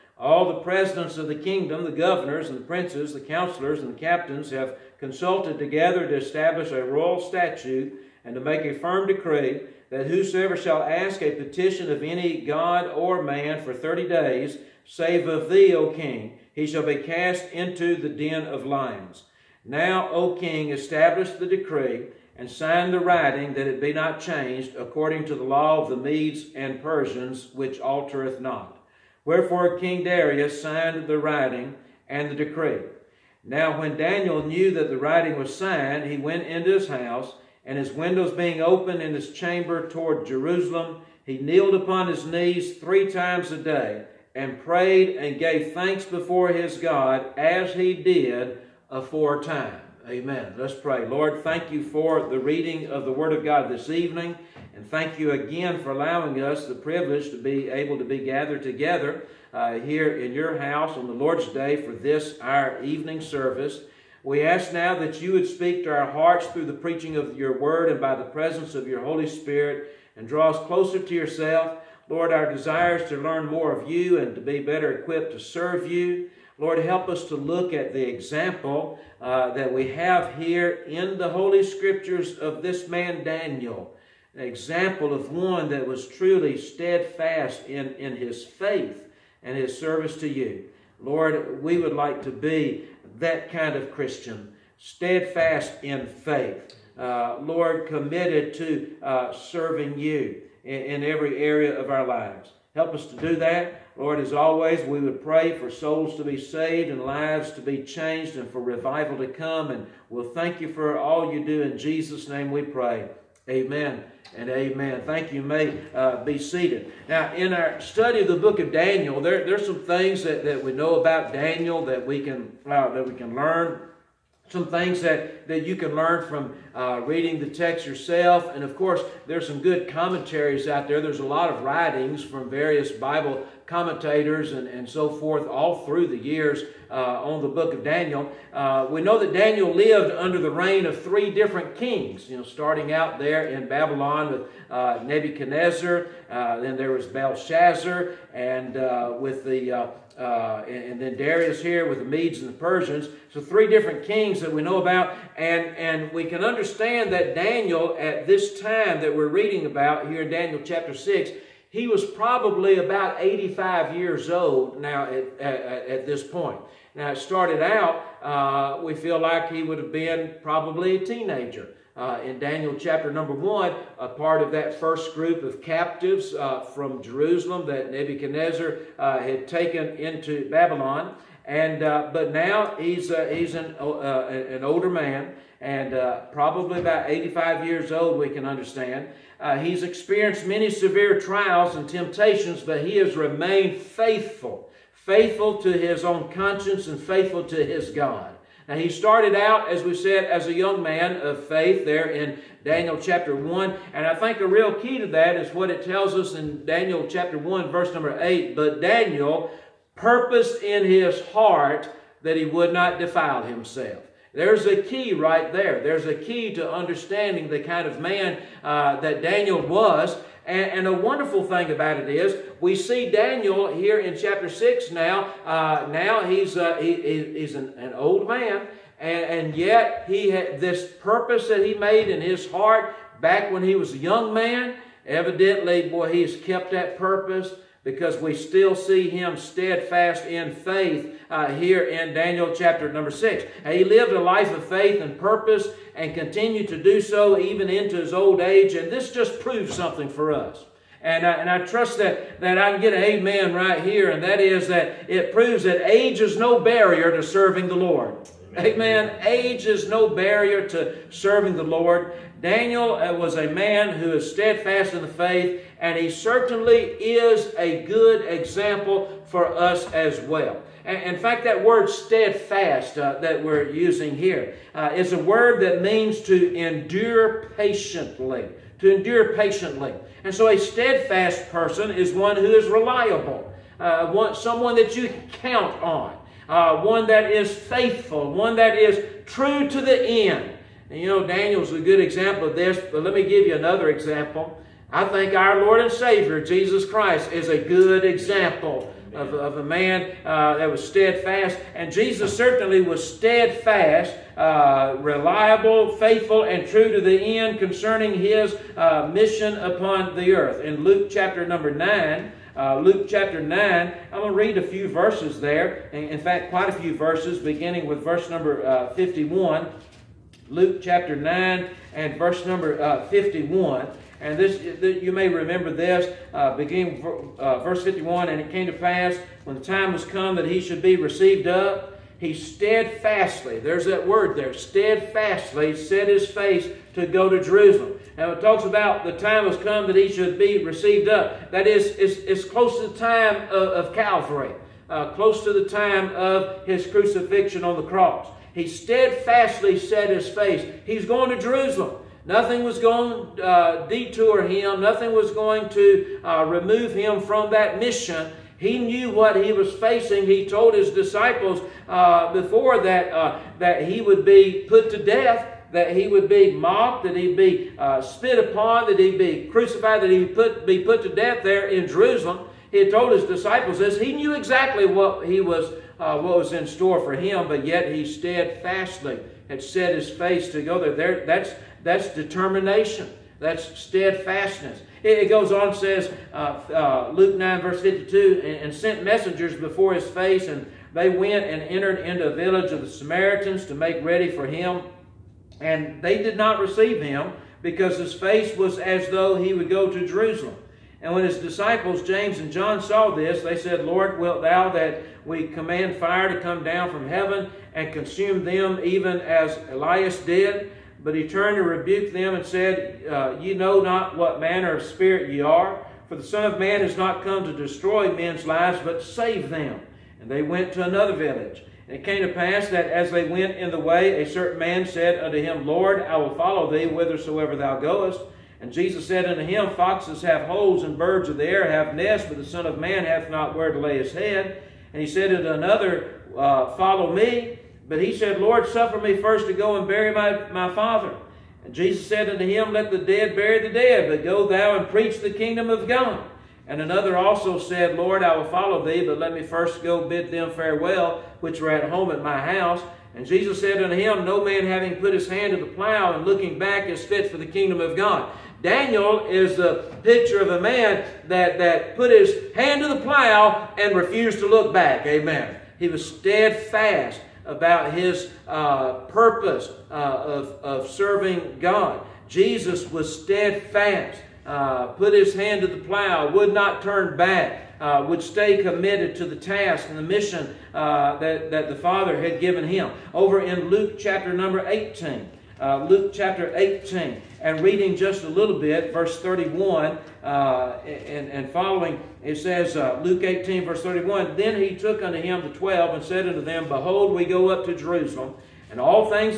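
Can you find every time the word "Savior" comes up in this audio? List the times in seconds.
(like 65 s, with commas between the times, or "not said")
295 s.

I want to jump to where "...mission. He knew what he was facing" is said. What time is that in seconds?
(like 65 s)
357 s.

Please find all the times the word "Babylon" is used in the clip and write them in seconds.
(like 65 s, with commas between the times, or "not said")
143 s, 180 s.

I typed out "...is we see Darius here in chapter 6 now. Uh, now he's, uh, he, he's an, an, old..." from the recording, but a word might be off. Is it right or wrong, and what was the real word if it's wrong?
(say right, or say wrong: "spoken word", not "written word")
wrong: "Daniel", not "Darius".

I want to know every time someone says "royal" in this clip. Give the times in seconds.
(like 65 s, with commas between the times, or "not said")
6 s.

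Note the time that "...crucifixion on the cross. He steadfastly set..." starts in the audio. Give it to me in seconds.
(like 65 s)
346 s.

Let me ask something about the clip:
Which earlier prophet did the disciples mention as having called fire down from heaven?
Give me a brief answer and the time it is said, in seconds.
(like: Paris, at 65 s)
Elias, at 409 s.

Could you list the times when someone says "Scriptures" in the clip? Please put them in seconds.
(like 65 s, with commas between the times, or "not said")
81 s.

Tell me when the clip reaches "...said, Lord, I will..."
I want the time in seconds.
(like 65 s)
447 s.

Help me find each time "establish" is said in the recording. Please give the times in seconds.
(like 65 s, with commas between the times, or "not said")
6 s, 20 s.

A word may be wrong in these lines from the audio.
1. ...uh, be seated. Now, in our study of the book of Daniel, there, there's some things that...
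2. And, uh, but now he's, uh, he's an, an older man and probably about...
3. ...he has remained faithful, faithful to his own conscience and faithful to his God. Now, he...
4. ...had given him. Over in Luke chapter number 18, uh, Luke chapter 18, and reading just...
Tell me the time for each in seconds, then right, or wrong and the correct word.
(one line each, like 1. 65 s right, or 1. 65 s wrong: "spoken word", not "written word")
1. 115 s right
2. 181 s right
3. 192 s right
4. 482 s right.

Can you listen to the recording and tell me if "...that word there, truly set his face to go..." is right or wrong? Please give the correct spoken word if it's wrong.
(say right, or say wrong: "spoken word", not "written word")
wrong: "steadfastly", not "truly".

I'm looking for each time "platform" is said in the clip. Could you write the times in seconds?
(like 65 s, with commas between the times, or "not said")
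not said.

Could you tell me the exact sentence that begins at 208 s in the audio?
But Daniel purposed in his heart that he would not defile himself.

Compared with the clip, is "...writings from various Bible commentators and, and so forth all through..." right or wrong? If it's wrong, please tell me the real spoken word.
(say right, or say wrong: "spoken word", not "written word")
right.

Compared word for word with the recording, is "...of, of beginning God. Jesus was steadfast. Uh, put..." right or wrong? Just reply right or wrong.
wrong.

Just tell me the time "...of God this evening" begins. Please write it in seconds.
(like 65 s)
53 s.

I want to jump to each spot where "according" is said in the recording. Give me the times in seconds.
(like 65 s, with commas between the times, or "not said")
24 s.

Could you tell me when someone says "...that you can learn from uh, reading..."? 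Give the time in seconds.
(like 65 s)
125 s.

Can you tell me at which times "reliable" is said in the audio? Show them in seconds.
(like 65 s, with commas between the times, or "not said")
282 s, 304 s.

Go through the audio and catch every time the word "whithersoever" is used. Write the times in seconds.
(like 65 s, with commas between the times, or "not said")
426 s.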